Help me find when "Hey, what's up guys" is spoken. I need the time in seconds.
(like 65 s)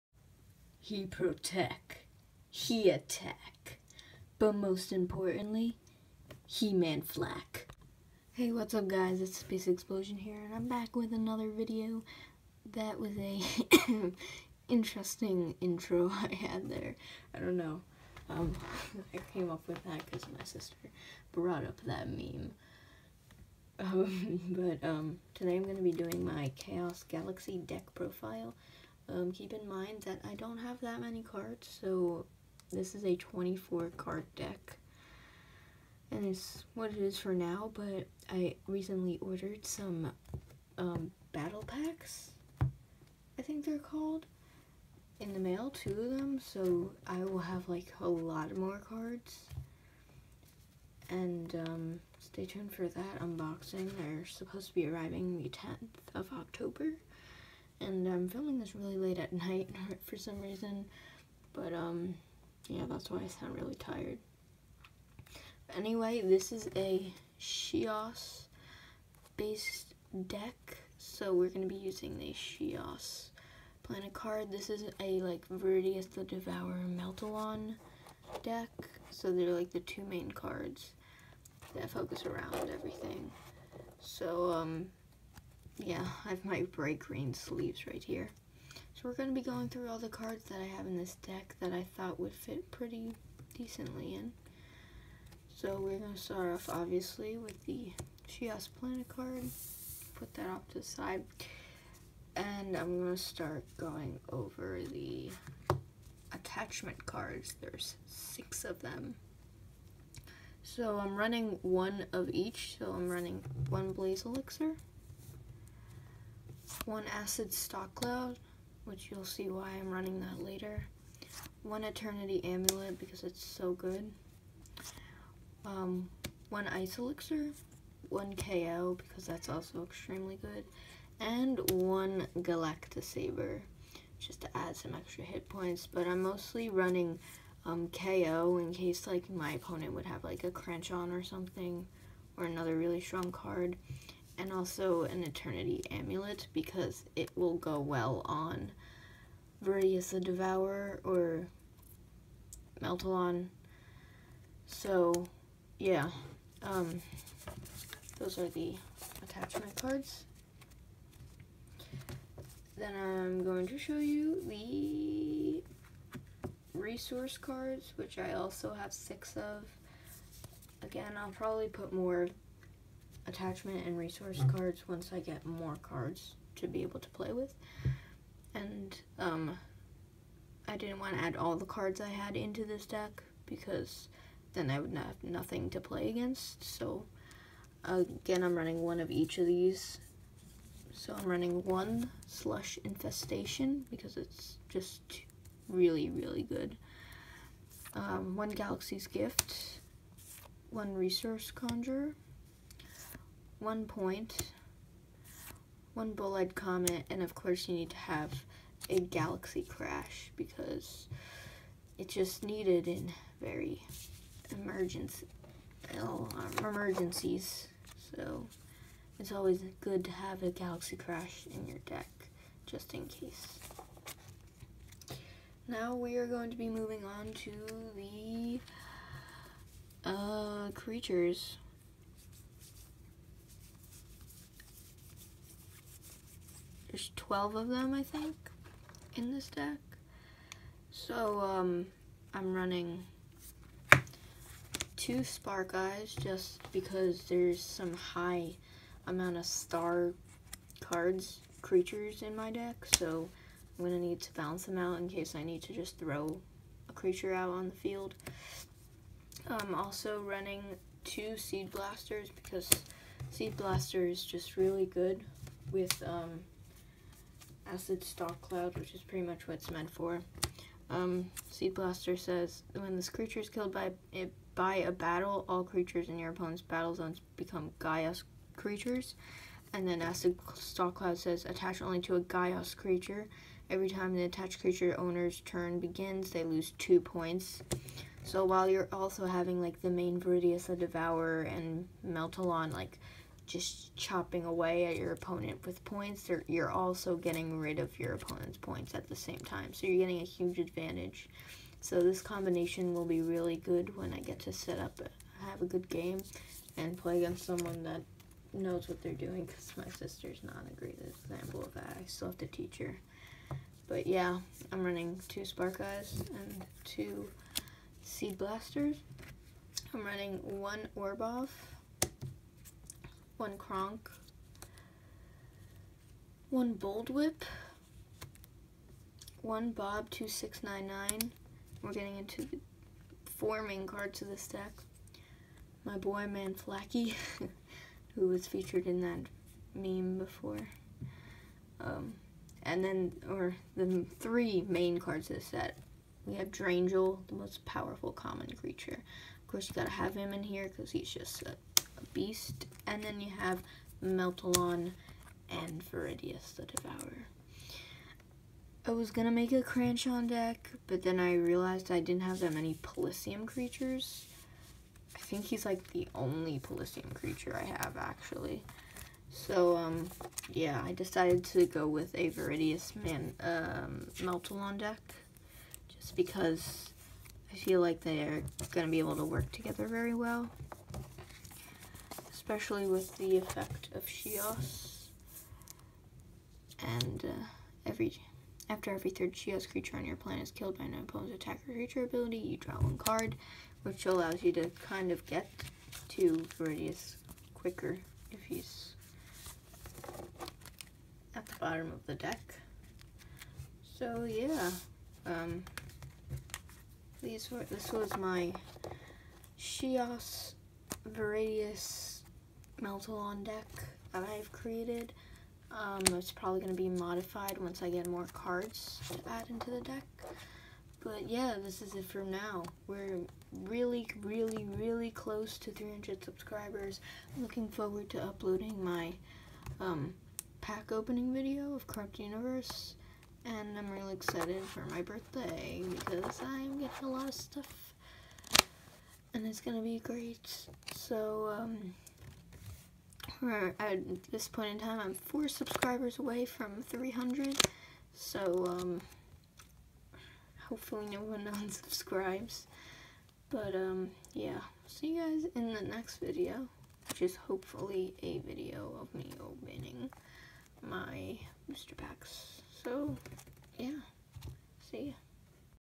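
8 s.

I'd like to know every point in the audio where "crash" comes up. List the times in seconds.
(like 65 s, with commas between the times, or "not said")
209 s, 220 s.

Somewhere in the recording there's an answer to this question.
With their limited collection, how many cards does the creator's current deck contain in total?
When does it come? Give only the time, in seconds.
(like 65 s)
33 s.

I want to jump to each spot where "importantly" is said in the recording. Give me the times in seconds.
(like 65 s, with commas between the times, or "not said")
4 s.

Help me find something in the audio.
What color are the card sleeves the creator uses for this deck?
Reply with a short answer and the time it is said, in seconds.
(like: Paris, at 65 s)
bright green, at 86 s.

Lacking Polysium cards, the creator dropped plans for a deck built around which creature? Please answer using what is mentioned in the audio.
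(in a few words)
Cranchon.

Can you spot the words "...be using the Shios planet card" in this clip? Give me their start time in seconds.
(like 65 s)
71 s.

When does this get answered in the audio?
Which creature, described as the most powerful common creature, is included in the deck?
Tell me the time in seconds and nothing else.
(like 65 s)
346 s.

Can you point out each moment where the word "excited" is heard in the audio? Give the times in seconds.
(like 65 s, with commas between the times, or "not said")
434 s.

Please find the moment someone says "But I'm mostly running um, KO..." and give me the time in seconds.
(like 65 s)
135 s.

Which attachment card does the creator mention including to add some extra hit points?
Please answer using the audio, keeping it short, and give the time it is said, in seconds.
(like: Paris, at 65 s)
Galacta Saber, at 132 s.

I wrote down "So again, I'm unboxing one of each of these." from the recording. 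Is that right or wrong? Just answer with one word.
wrong.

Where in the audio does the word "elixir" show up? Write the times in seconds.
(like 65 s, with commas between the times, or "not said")
114 s, 126 s.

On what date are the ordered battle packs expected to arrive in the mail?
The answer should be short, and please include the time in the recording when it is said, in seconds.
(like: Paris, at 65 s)
10th of October, at 55 s.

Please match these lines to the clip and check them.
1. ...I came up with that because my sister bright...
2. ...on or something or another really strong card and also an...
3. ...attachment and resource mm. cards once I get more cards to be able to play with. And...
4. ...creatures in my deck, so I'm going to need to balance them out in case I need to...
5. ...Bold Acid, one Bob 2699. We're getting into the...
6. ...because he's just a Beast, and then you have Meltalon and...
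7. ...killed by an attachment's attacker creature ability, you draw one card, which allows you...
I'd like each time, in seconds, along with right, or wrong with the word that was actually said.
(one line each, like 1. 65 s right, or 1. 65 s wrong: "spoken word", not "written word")
1. 19 s wrong: "brought", not "bright"
2. 140 s right
3. 173 s right
4. 251 s right
5. 326 s wrong: "Whip", not "Acid"
6. 350 s right
7. 390 s wrong: "opponent", not "attachment".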